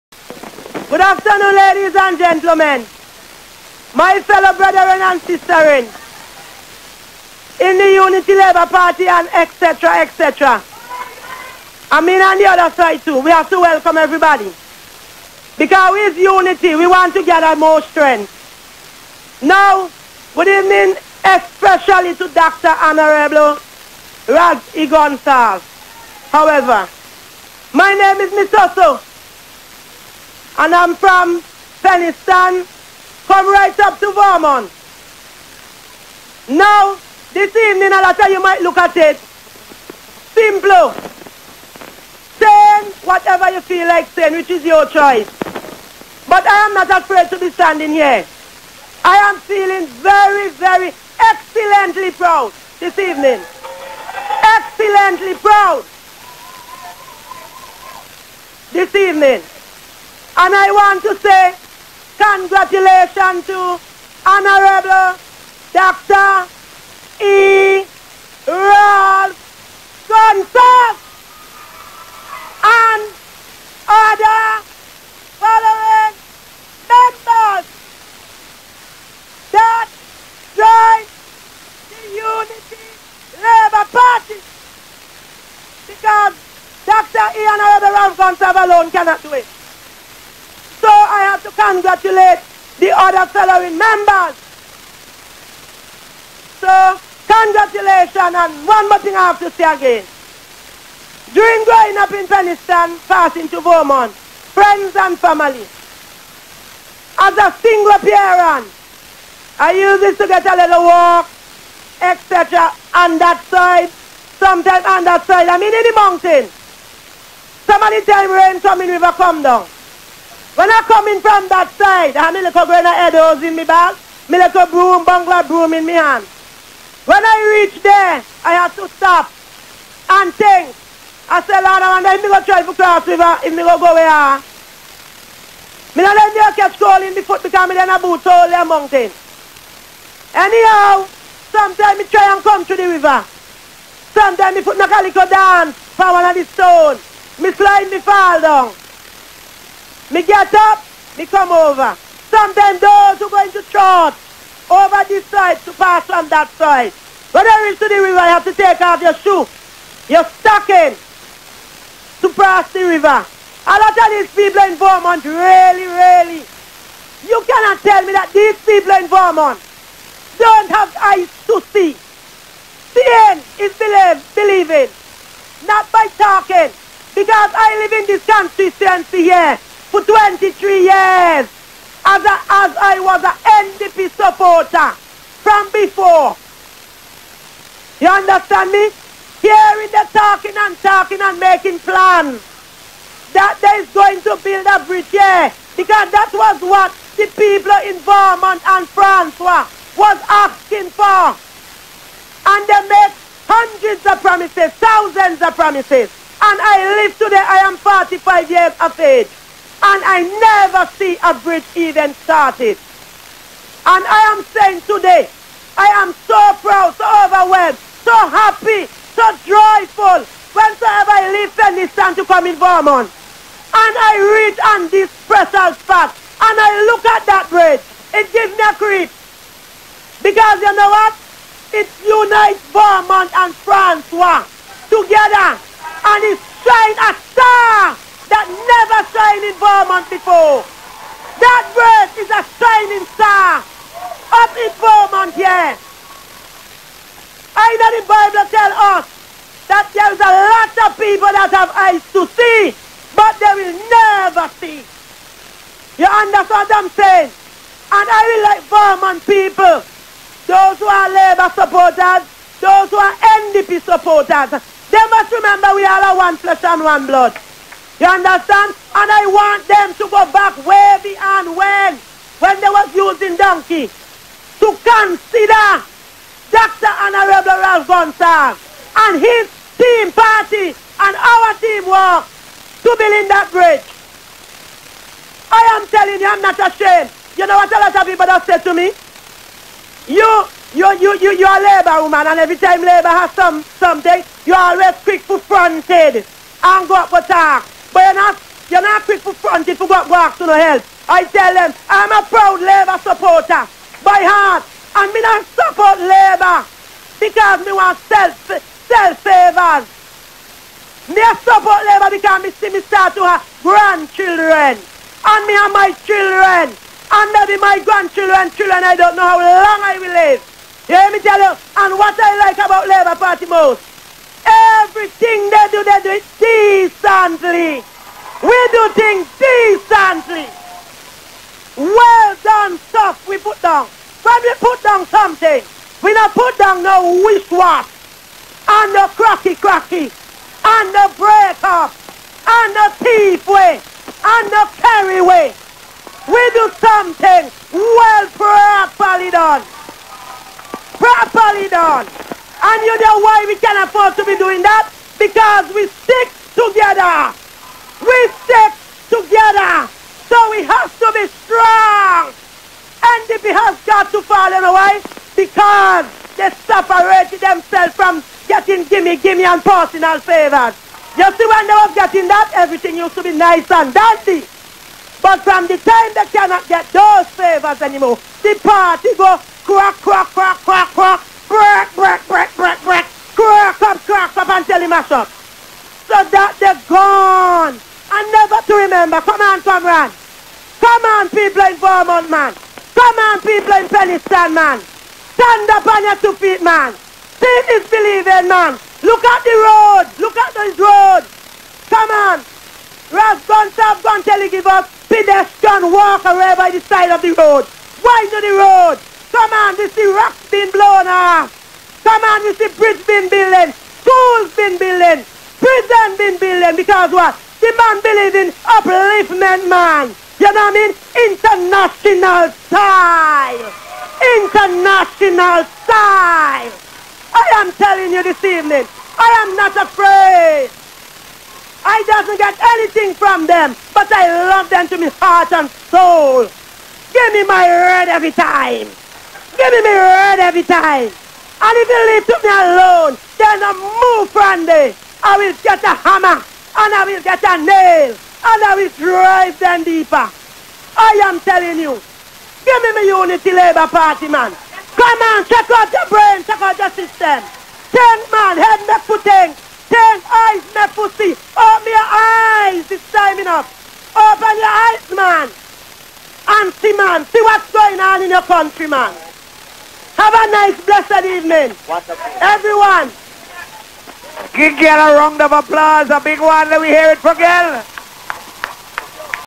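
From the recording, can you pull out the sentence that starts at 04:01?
That verse is a shining star up in Vermont here.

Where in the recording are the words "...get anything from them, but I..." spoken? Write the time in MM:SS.
07:12.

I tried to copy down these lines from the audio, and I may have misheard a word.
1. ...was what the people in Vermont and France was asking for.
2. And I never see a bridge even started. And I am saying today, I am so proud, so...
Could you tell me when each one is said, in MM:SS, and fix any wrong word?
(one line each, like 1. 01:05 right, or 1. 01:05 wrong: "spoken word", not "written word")
1. 03:16 right
2. 03:29 right.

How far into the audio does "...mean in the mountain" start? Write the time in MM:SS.
01:55.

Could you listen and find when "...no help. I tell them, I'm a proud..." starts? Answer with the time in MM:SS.
05:00.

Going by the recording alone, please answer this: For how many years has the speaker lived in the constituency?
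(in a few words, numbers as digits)
23.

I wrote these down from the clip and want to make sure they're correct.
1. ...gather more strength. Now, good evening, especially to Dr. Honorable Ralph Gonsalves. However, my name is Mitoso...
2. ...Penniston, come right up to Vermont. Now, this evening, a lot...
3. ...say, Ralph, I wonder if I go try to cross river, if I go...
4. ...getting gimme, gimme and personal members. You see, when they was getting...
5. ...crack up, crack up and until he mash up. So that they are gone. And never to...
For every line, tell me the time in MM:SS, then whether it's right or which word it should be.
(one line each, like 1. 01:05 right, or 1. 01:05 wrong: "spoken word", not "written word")
1. 00:17 right
2. 00:31 right
3. 02:11 wrong: "Lord", not "Ralph"
4. 06:08 wrong: "favors", not "members"
5. 06:23 right.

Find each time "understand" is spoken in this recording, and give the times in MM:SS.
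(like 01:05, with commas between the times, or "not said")
03:08, 04:16, 04:28.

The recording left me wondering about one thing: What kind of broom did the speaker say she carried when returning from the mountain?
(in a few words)
bungalow broom.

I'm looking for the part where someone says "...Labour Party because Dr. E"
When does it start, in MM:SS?
01:23.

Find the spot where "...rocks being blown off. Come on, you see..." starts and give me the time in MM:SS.
06:50.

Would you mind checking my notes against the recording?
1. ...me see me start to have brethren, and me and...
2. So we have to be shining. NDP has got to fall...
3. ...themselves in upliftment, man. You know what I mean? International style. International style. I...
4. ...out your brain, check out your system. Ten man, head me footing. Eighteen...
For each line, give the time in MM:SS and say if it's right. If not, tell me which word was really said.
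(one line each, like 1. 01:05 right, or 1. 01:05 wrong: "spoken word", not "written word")
1. 05:12 wrong: "grandchildren", not "brethren"
2. 06:00 wrong: "strong", not "shining"
3. 06:58 wrong: "believes", not "themselves"
4. 07:35 wrong: "Ten", not "Eighteen".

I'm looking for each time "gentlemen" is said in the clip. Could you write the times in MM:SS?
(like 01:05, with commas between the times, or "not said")
00:02.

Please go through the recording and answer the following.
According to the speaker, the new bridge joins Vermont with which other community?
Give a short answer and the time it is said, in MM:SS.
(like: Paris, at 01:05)
Francois, at 03:53.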